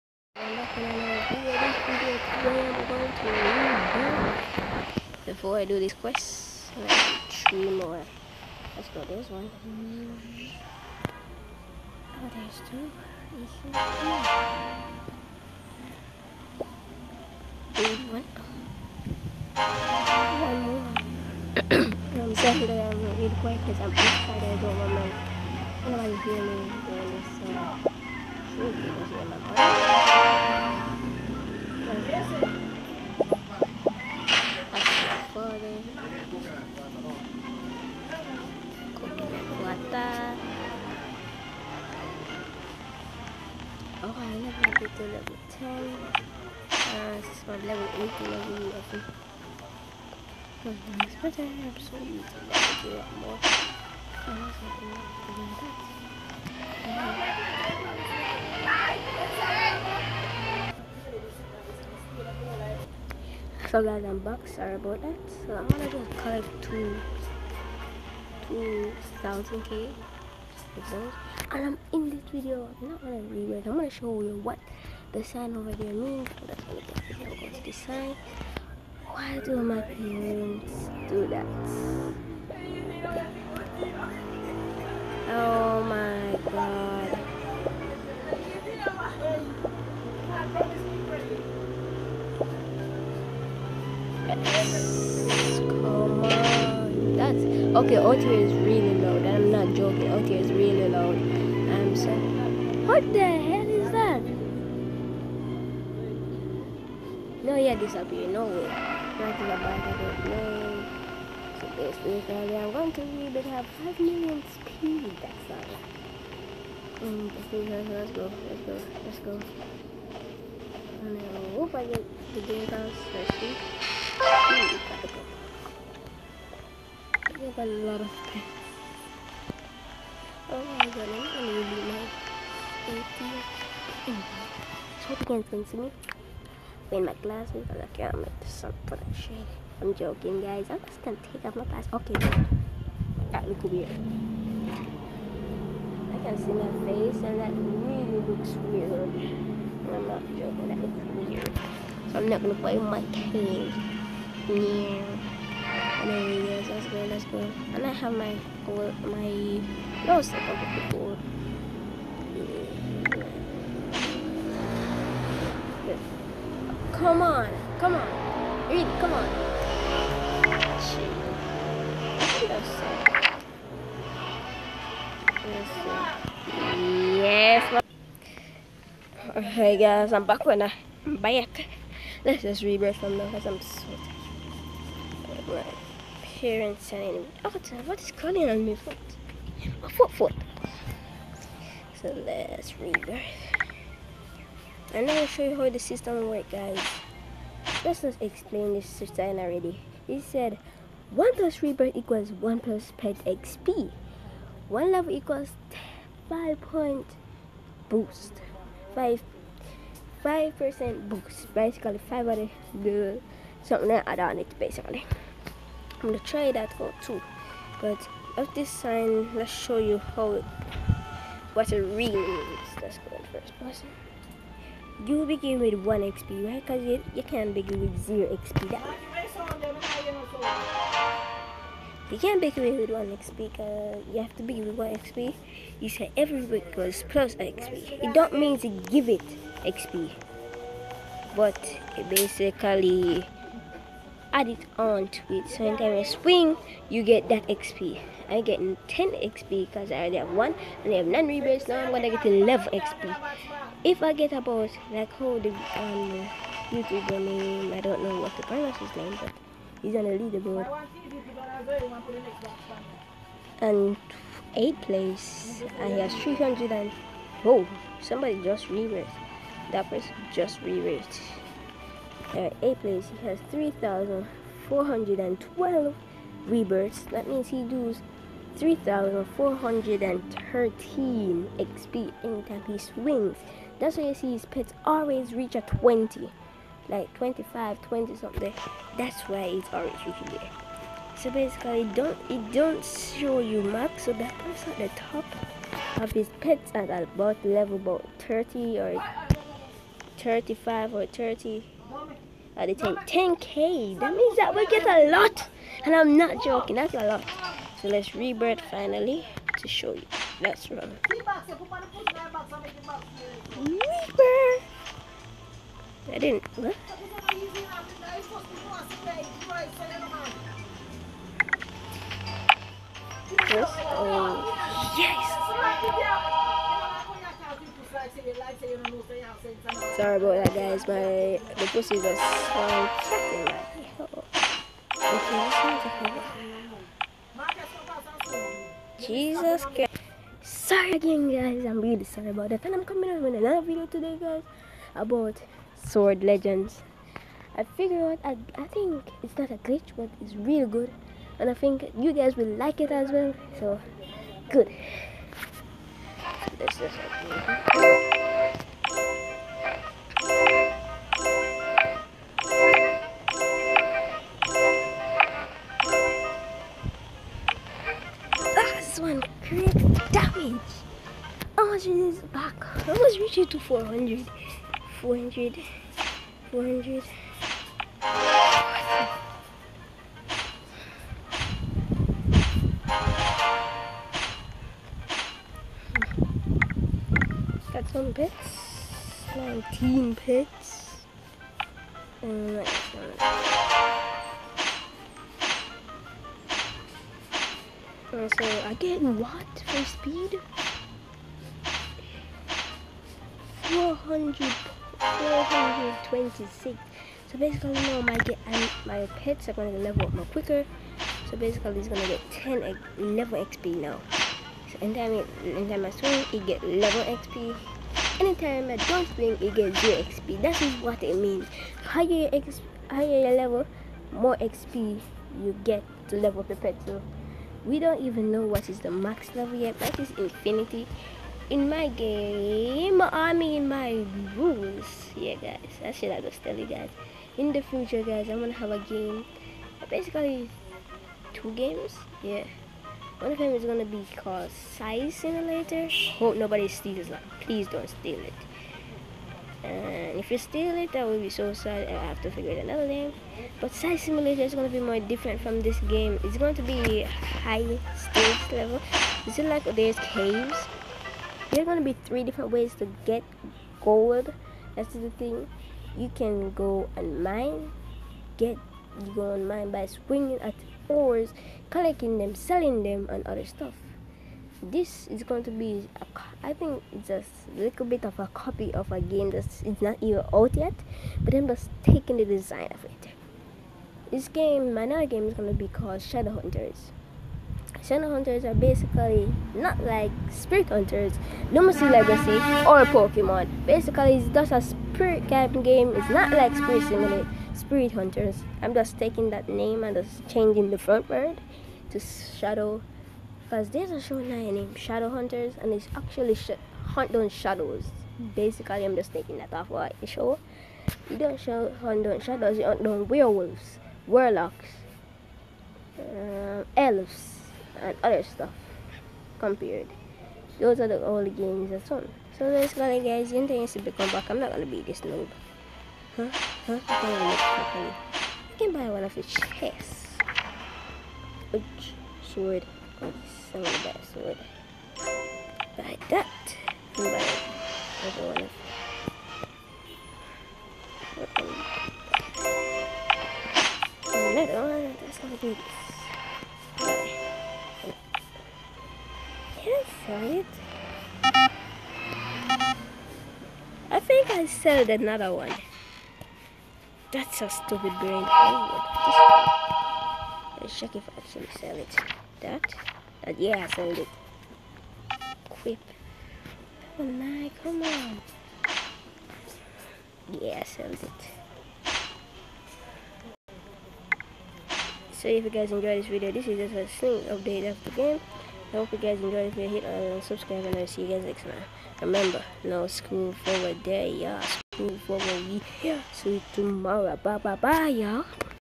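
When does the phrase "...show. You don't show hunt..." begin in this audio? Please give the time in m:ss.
8:30.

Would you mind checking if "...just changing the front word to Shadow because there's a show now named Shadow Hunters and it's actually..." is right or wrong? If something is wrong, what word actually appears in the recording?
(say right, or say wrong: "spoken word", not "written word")
right.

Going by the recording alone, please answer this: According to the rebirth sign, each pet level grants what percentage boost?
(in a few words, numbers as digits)
5%.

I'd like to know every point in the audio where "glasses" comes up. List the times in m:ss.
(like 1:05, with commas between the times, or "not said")
2:17, 2:21.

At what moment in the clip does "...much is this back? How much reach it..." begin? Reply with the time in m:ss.
6:11.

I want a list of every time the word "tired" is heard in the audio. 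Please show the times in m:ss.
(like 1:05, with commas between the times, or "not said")
3:03.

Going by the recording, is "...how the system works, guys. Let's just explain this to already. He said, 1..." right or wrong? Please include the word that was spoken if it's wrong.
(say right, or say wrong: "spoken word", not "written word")
right.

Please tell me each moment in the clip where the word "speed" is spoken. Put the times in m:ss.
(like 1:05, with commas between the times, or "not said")
1:54, 6:39.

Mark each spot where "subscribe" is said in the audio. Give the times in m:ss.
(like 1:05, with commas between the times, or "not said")
9:40.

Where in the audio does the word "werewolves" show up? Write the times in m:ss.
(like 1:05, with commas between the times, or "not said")
8:33.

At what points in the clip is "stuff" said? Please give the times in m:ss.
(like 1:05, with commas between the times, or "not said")
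7:53, 8:38.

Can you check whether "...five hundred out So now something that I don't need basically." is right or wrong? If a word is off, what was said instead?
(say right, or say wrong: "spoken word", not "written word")
right.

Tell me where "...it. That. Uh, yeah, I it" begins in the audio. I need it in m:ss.
9:21.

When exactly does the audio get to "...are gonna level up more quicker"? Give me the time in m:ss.
6:49.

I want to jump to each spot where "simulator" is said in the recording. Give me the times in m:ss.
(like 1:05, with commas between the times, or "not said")
7:25, 7:33, 8:16.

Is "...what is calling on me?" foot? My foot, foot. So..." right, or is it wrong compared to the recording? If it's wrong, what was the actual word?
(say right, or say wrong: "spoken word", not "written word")
right.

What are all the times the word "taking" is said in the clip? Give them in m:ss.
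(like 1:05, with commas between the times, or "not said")
8:01, 8:18, 8:29.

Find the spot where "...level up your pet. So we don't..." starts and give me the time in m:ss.
7:06.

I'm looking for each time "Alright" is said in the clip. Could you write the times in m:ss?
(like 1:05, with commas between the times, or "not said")
2:59.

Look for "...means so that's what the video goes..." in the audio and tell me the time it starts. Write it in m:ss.
1:15.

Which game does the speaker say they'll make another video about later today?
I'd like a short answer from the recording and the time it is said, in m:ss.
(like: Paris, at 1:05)
Sword Legends, at 5:45.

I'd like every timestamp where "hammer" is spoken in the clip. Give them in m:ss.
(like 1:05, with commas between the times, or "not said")
not said.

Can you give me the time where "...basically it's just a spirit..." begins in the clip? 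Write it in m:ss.
8:13.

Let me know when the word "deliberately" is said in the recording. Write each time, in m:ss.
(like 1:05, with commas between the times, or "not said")
not said.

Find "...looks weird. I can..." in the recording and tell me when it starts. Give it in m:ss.
2:23.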